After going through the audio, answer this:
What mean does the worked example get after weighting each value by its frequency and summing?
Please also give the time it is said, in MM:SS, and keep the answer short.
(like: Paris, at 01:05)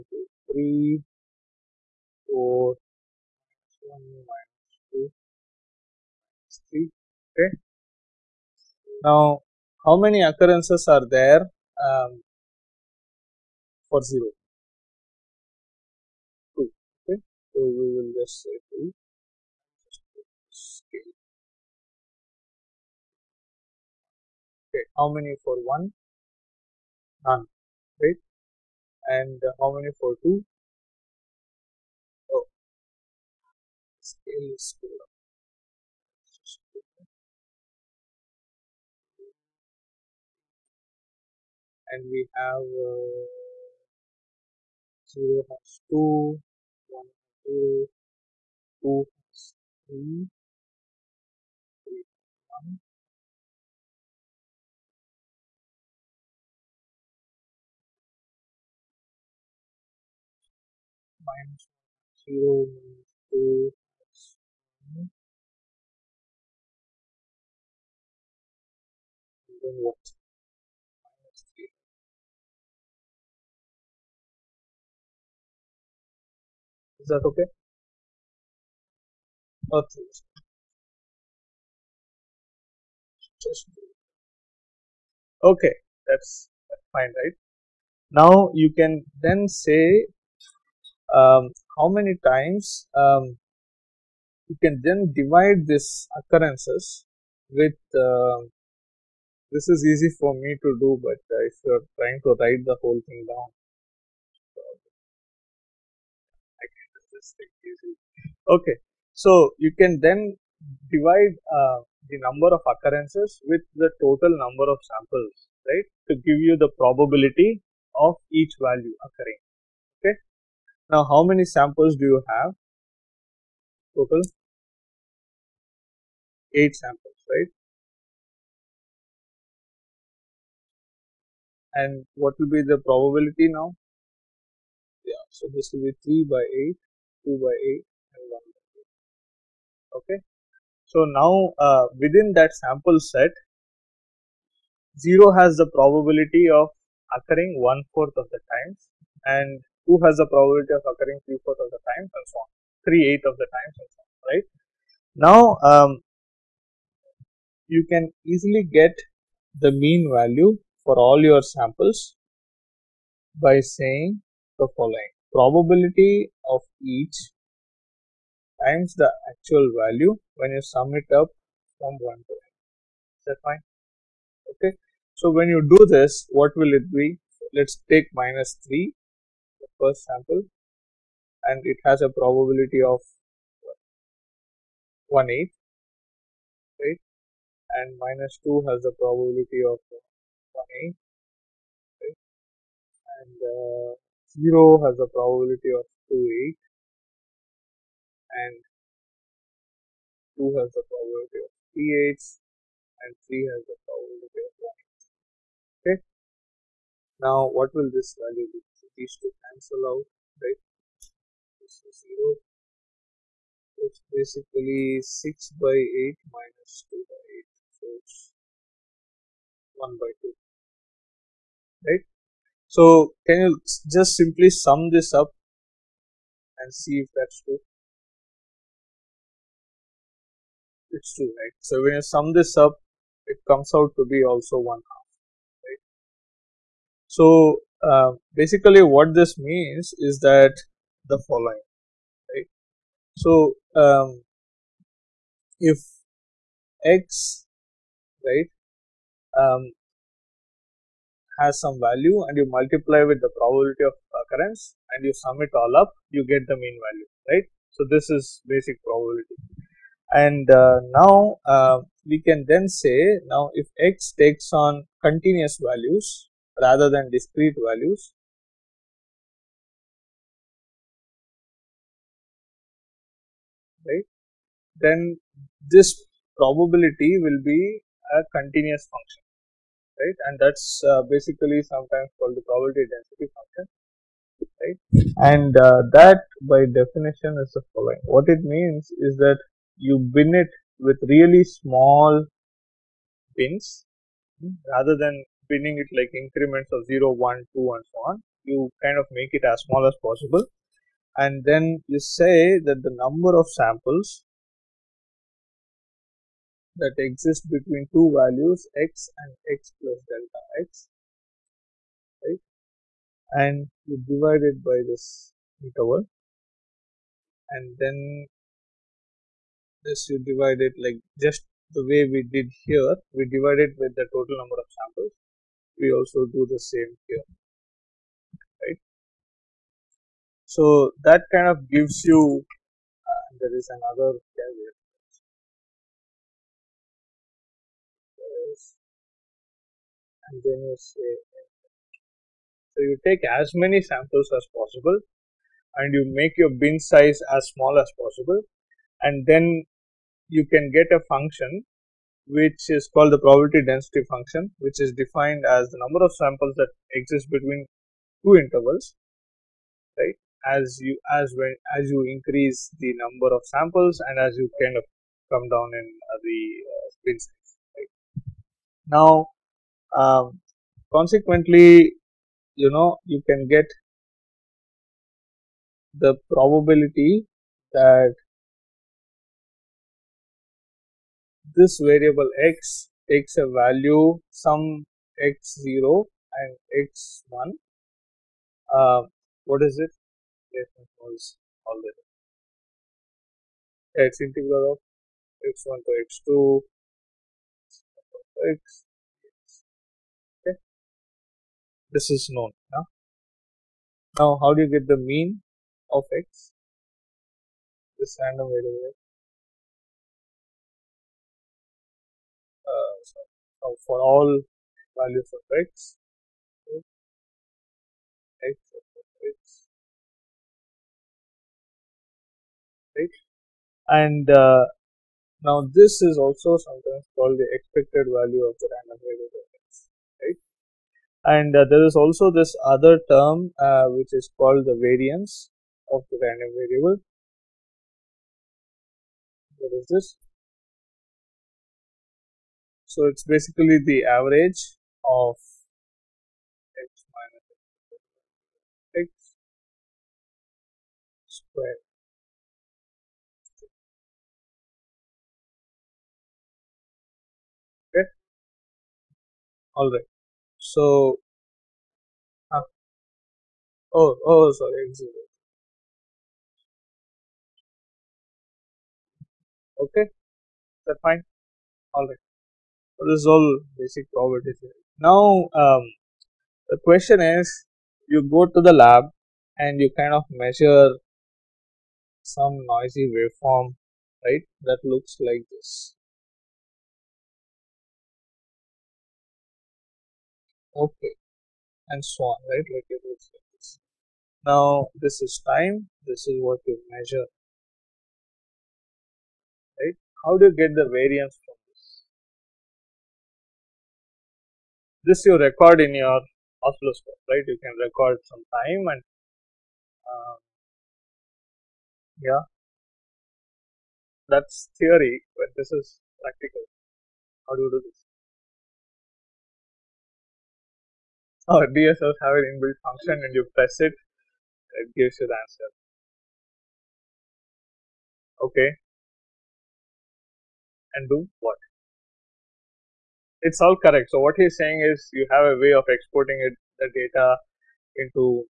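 1/2, at 03:54.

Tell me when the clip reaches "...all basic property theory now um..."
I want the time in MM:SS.
07:53.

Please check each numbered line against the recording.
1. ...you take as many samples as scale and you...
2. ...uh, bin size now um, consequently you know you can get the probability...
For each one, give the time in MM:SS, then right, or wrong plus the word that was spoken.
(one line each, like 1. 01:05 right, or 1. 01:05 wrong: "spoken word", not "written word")
1. 05:42 wrong: "possible", not "scale"
2. 06:06 right.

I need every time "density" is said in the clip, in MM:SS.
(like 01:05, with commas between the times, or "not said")
04:42, 05:53.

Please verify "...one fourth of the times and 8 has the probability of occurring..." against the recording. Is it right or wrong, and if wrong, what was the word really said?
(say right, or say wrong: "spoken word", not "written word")
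wrong: "2", not "8".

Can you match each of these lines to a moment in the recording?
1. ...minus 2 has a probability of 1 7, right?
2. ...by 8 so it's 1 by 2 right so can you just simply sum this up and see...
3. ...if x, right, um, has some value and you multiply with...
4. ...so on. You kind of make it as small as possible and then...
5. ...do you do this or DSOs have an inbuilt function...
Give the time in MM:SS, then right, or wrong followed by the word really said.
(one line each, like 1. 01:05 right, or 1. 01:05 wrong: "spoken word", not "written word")
1. 03:07 wrong: "8", not "7"
2. 03:37 right
3. 04:05 right
4. 04:57 right
5. 08:37 right.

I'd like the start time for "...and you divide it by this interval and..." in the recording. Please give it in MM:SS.
05:13.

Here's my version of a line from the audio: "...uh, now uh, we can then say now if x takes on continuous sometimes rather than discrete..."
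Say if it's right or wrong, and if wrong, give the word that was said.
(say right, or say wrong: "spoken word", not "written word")
wrong: "values", not "sometimes".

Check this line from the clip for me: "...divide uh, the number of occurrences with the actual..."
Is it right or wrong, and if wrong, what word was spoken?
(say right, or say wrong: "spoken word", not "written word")
wrong: "total", not "actual".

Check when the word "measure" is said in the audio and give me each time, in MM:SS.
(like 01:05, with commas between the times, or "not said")
08:00, 08:16.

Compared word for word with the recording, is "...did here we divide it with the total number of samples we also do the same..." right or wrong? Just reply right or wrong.
right.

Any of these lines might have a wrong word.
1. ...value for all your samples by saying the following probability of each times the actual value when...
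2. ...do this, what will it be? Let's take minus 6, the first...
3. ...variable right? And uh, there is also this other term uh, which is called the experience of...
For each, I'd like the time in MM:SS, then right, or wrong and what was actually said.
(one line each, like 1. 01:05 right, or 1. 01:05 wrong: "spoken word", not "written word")
1. 02:40 right
2. 02:55 wrong: "3", not "6"
3. 07:09 wrong: "variance", not "experience".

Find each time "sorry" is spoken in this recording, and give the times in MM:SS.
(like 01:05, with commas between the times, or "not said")
07:44.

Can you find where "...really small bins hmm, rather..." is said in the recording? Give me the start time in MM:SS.
04:51.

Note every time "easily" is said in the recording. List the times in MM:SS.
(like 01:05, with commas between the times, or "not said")
01:47, 02:38.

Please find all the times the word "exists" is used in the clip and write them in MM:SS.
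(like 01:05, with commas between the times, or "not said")
05:07, 05:57.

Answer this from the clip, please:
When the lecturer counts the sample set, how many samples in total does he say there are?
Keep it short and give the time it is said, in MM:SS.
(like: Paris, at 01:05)
8, at 02:03.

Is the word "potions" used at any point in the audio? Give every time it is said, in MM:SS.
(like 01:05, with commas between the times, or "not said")
not said.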